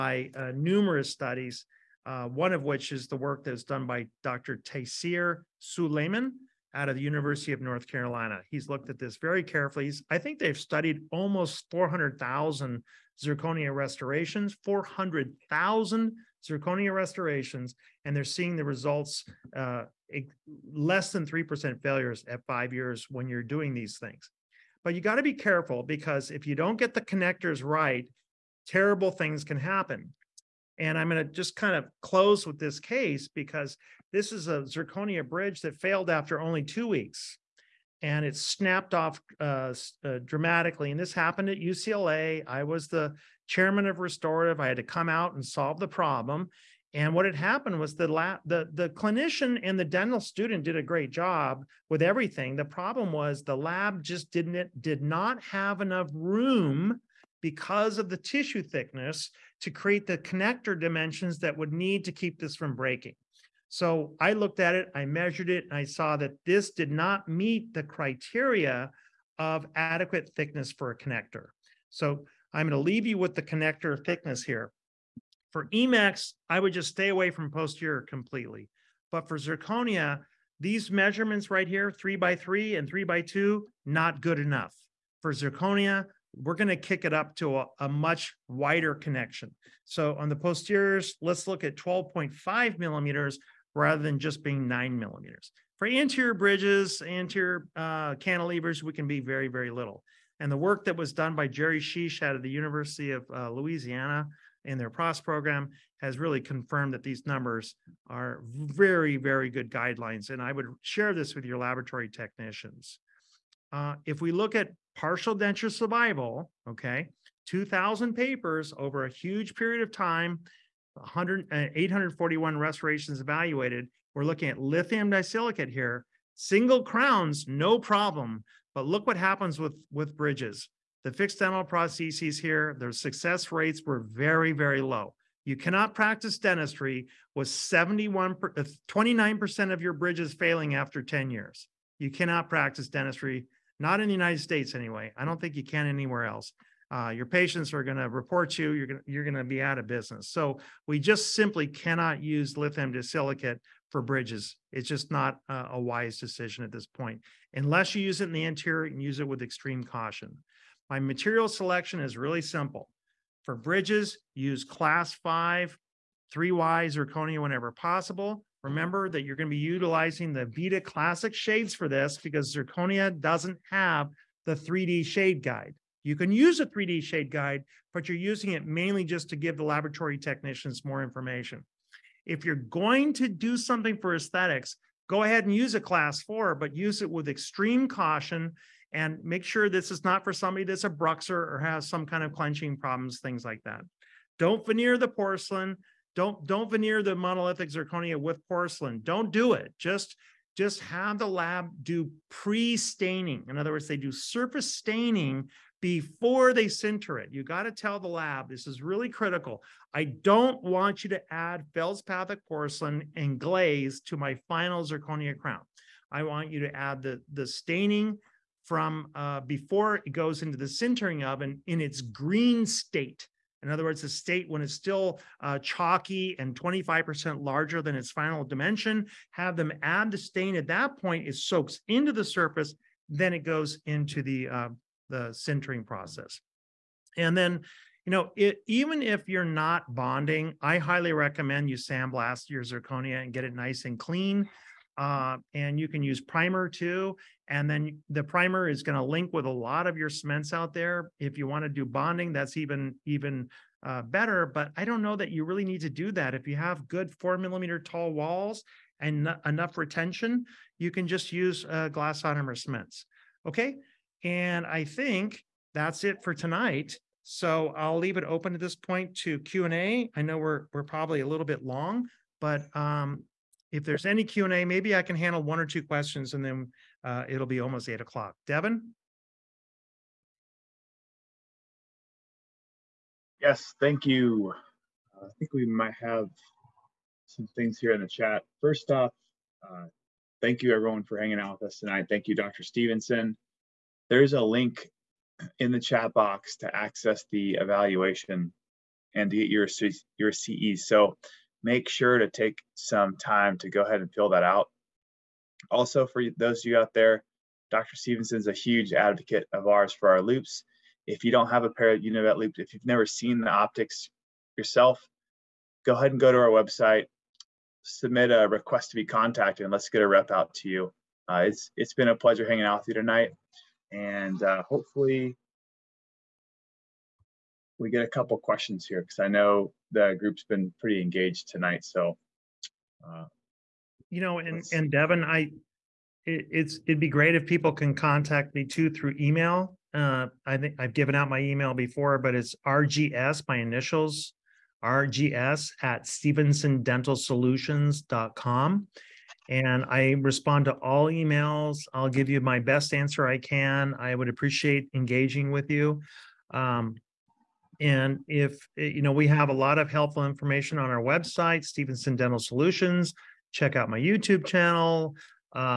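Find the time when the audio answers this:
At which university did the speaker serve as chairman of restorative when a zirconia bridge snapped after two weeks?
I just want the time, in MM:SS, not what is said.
00:41.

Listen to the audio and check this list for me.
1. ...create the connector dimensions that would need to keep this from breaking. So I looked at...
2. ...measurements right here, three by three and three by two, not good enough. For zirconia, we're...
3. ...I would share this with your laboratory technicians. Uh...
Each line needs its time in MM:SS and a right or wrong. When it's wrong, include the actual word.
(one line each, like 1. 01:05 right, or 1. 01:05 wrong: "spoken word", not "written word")
1. 00:59 right
2. 01:20 right
3. 01:50 right.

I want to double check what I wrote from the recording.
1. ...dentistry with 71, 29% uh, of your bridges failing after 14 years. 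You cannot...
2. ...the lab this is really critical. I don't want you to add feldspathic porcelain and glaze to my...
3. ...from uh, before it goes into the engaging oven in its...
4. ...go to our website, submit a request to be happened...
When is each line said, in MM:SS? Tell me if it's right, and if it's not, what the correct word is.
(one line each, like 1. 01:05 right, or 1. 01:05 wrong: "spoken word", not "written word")
1. 02:16 wrong: "10", not "14"
2. 03:27 right
3. 03:38 wrong: "sintering", not "engaging"
4. 05:16 wrong: "contacted", not "happened".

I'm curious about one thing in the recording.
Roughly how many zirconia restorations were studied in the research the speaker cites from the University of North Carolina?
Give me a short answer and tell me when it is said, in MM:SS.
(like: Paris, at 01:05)
400,000, at 00:11.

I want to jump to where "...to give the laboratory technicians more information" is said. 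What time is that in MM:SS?
02:59.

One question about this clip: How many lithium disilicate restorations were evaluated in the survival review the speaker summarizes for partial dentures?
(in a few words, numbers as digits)
841.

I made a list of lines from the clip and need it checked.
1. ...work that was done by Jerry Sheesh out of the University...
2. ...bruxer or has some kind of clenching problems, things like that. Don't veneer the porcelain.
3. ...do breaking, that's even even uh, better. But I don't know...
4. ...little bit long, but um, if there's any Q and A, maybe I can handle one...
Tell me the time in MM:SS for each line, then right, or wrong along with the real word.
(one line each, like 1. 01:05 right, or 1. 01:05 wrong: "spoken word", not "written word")
1. 01:40 right
2. 03:10 right
3. 04:11 wrong: "bonding", not "breaking"
4. 04:31 right.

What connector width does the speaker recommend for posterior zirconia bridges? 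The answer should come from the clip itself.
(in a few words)
12.5 millimeters.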